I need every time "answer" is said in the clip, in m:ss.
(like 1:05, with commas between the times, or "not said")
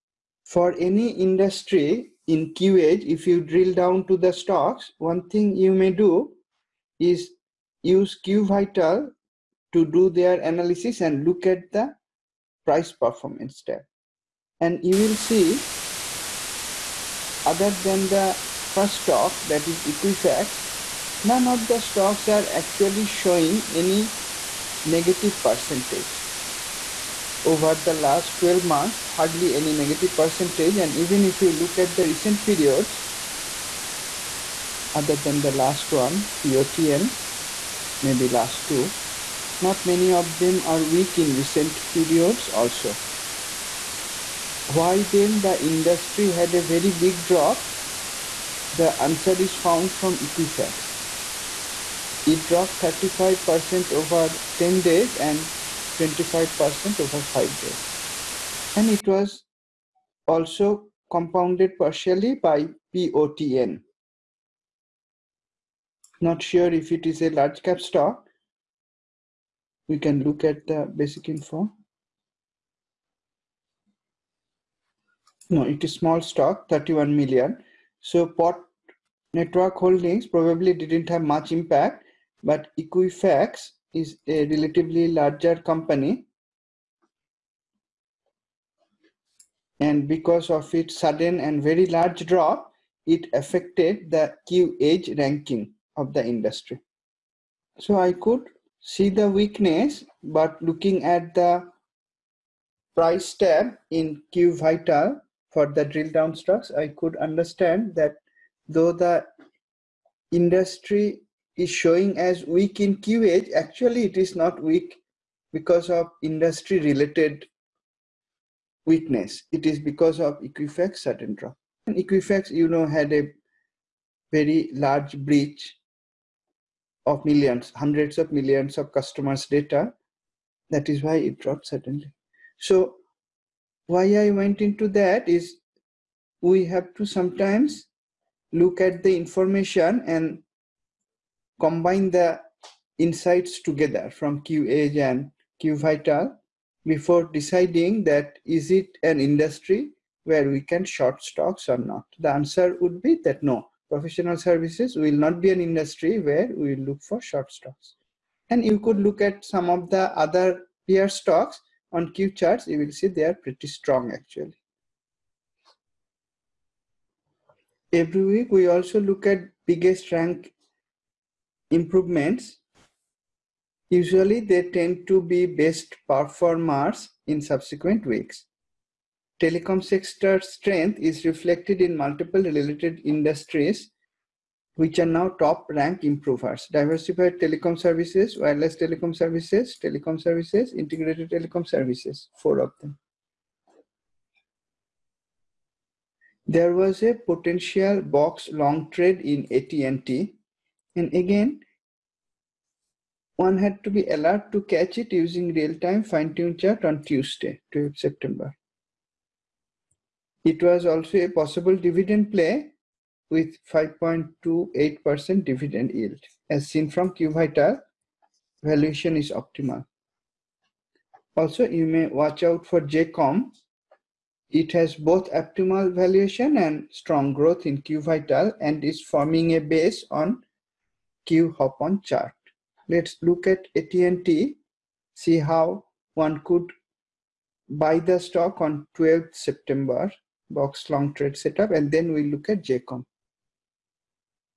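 0:48, 2:32.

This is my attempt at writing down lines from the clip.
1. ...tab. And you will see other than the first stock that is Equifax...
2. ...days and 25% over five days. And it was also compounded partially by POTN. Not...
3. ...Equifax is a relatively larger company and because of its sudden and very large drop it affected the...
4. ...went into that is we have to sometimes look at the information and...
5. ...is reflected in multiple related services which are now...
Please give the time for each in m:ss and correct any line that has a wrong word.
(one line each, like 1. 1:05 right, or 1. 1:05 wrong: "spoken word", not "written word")
1. 0:13 right
2. 0:54 right
3. 1:22 right
4. 2:14 right
5. 3:00 wrong: "industries", not "services".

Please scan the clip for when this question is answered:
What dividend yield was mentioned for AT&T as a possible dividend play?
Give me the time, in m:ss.
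3:33.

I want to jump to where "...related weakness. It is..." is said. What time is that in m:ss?
1:56.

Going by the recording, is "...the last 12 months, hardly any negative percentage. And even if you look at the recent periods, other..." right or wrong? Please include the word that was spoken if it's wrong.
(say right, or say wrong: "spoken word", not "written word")
right.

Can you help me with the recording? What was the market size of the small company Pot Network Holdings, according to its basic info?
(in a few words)
31 million.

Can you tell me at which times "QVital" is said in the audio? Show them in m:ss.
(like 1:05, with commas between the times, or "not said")
0:08, 2:25, 3:37, 3:47.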